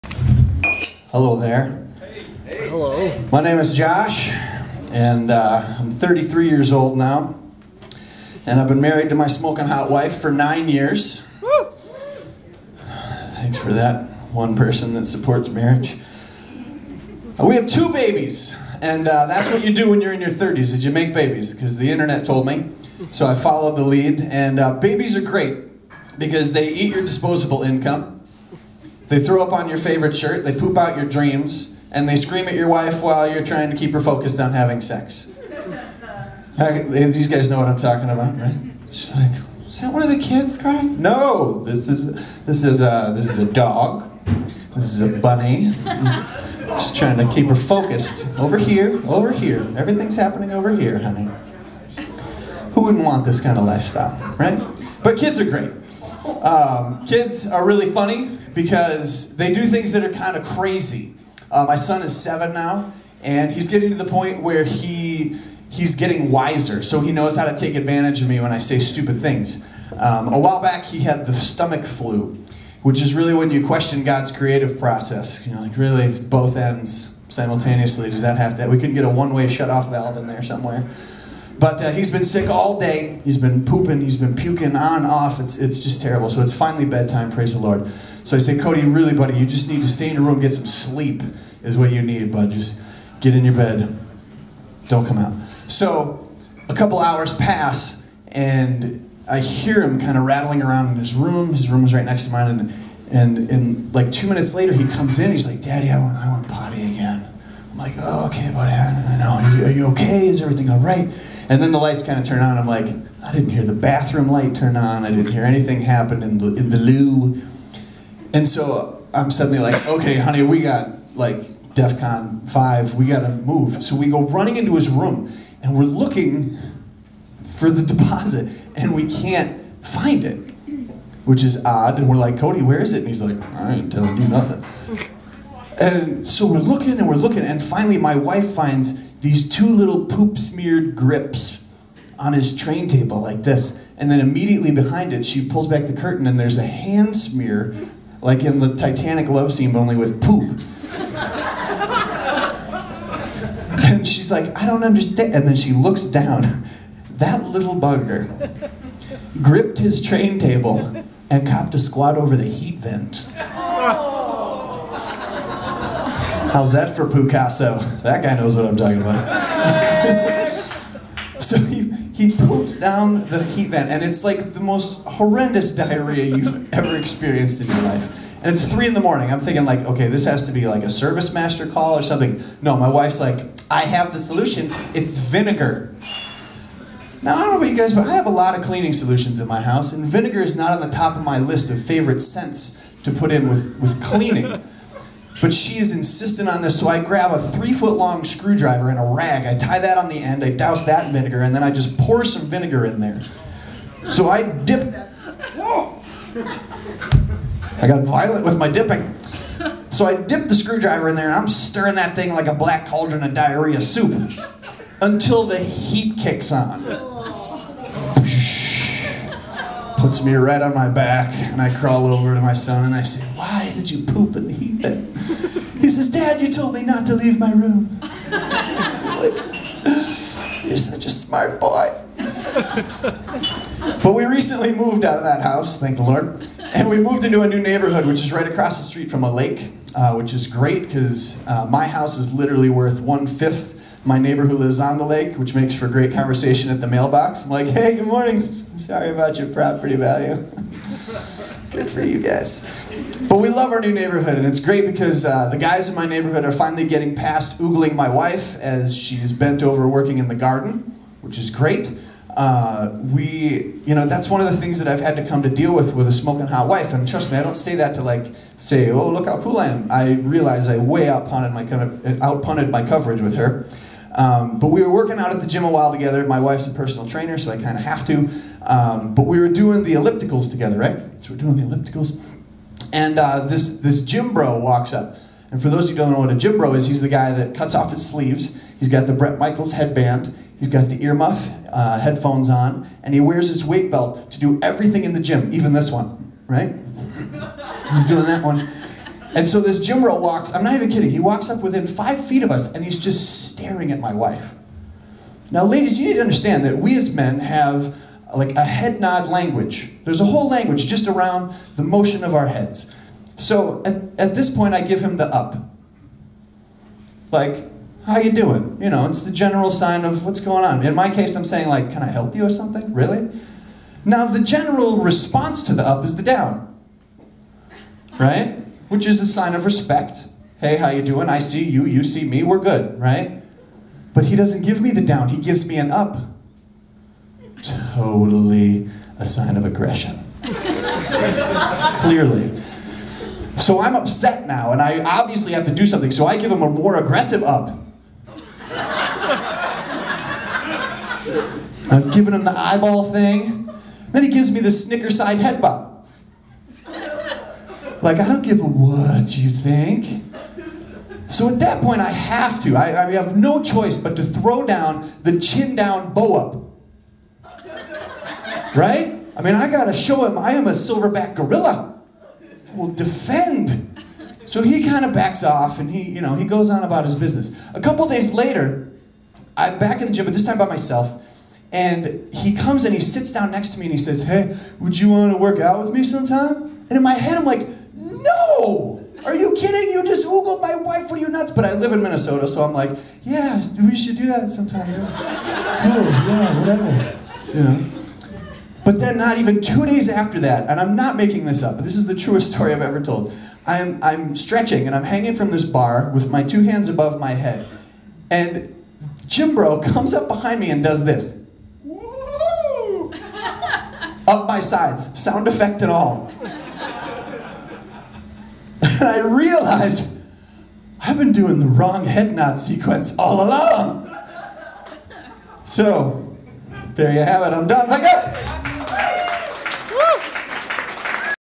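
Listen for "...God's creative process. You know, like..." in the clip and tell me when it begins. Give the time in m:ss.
1:14.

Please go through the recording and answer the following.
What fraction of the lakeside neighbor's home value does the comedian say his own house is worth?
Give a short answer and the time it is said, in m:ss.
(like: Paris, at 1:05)
One fifth, at 4:03.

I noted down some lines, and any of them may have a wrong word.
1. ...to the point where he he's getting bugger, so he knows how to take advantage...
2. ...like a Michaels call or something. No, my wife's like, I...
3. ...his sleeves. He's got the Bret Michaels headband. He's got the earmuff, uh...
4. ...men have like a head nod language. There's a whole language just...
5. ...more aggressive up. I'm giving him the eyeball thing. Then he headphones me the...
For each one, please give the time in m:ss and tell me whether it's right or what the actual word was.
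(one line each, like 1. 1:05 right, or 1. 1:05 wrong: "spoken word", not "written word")
1. 1:03 wrong: "wiser", not "bugger"
2. 3:00 wrong: "ServiceMaster", not "Michaels"
3. 4:47 right
4. 5:07 right
5. 5:46 wrong: "gives", not "headphones".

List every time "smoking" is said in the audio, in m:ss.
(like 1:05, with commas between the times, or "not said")
0:09, 4:26.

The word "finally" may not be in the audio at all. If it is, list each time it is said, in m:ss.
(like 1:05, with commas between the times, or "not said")
1:26, 2:17, 4:16.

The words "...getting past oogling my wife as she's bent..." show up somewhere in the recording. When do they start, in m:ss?
4:16.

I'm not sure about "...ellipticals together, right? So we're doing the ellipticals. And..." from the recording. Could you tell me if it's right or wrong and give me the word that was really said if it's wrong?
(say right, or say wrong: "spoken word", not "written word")
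right.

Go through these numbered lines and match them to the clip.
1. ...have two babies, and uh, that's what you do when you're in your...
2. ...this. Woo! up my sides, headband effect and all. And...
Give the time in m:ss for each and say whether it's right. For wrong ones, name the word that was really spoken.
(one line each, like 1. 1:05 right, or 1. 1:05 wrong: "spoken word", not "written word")
1. 0:17 right
2. 6:51 wrong: "sound", not "headband".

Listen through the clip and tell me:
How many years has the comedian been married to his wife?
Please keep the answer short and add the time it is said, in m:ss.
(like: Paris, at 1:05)
9, at 0:10.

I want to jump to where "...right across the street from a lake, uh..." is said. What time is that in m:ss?
3:58.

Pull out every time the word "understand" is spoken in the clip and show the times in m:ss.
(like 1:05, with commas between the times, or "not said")
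2:34, 5:06.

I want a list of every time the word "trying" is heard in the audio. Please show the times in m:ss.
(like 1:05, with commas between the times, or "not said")
0:33, 0:46.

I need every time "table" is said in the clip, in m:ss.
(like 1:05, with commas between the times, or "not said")
2:22, 2:40.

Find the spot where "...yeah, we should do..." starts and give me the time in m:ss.
6:33.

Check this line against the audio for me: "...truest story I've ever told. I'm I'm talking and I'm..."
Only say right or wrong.
wrong.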